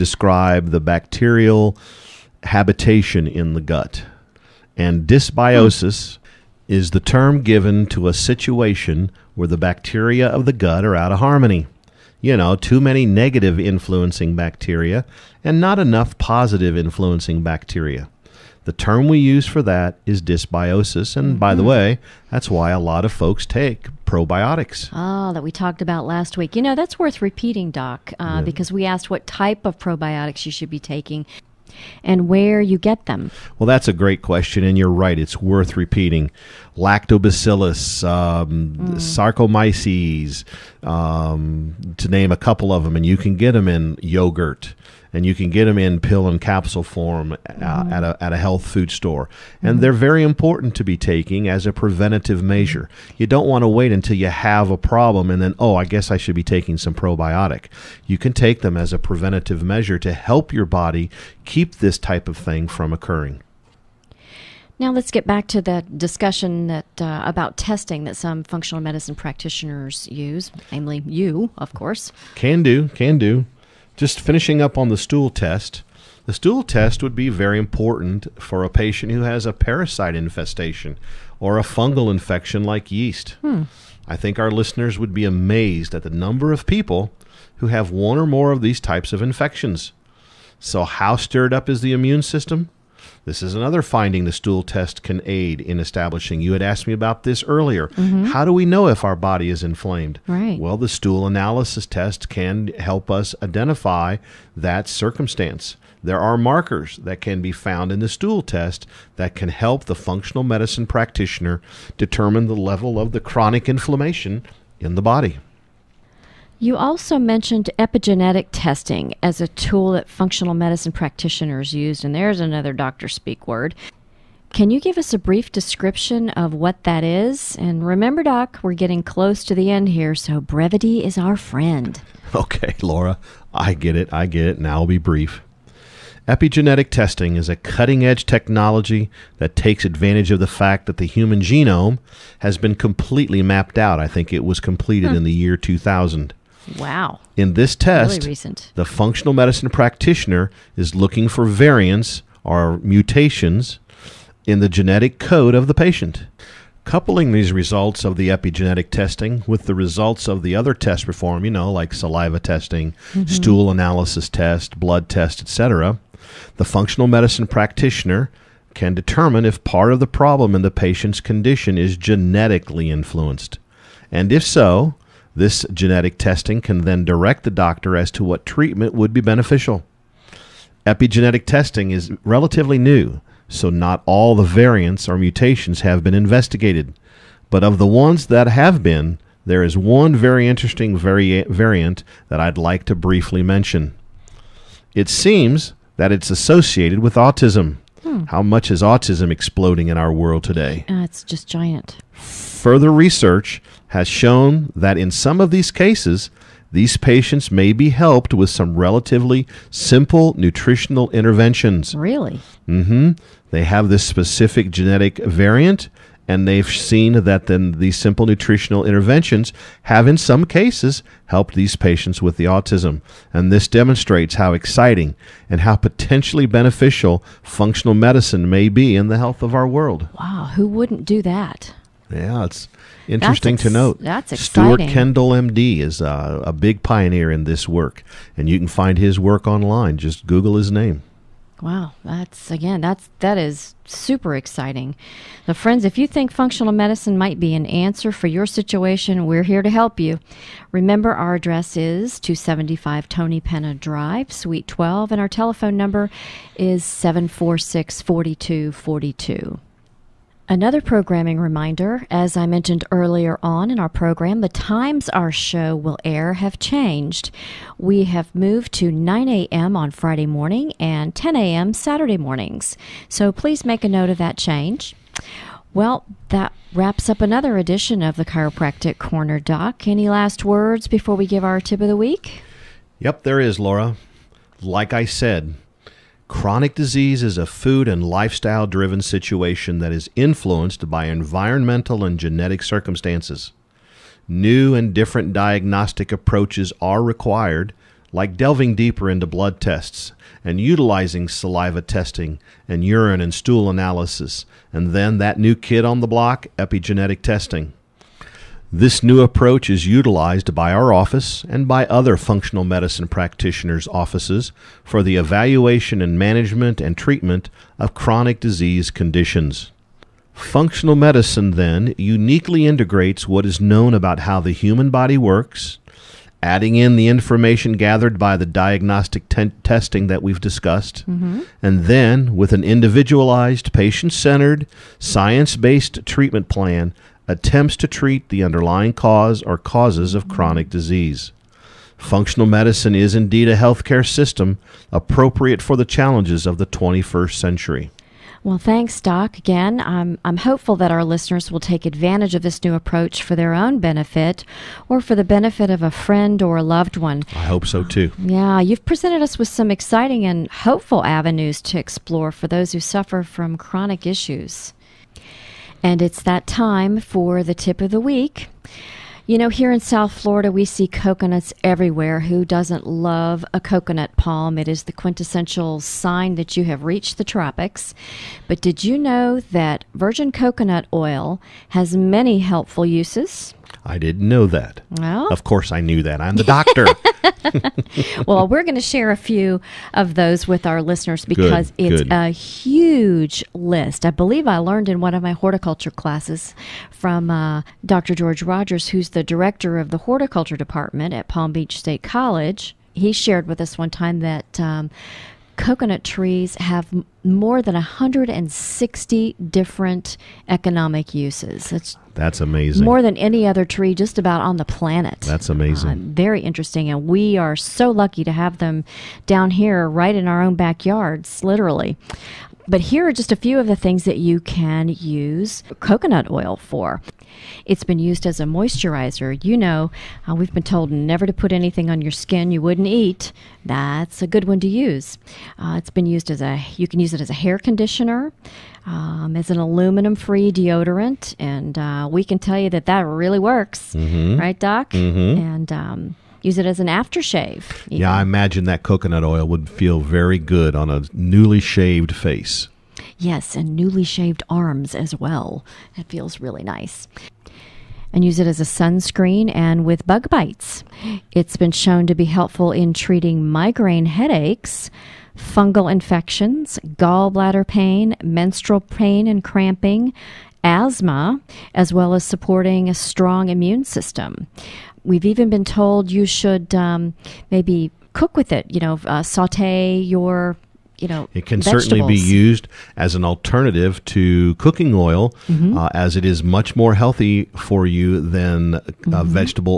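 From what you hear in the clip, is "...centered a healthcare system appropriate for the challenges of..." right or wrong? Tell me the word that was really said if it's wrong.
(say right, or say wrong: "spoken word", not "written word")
wrong: "indeed", not "centered".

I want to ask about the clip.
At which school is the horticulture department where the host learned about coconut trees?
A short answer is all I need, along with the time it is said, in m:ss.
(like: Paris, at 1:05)
Palm Beach State College, at 6:41.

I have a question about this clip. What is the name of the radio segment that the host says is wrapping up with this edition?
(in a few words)
Chiropractic Corner.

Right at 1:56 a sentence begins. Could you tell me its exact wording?
You also mentioned epigenetic testing as a tool that functional medicine practitioners use, and there's another doctor speak word.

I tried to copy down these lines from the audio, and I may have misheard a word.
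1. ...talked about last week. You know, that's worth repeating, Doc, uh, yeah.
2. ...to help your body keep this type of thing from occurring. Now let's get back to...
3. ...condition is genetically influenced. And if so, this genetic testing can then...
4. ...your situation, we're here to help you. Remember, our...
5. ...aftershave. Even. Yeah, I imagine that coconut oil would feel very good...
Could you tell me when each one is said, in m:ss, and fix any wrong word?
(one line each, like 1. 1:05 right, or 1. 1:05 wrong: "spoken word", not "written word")
1. 0:25 right
2. 0:59 right
3. 2:51 right
4. 4:08 right
5. 7:26 right.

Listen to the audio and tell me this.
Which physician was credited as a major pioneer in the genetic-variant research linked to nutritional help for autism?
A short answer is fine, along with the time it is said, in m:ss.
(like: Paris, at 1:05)
Stuart Kendall, at 3:54.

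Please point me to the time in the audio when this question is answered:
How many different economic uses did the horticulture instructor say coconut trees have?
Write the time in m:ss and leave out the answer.
6:47.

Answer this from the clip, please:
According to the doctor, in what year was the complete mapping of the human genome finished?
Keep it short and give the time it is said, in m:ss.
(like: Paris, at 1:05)
2000, at 2:25.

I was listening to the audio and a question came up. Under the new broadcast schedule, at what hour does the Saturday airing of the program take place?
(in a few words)
10 a.m.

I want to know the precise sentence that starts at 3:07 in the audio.
But of the ones that have been, there is one very interesting vari- variant that I'd like to briefly mention.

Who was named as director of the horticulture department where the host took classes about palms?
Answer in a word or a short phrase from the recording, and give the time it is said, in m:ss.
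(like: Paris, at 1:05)
George Rogers, at 6:37.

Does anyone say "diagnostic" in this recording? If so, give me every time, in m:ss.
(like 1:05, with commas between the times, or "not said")
4:55, 5:28.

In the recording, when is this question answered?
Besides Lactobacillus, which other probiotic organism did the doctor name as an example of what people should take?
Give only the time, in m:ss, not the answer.
0:38.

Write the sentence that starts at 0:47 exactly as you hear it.
uh, at, a, at a health food store.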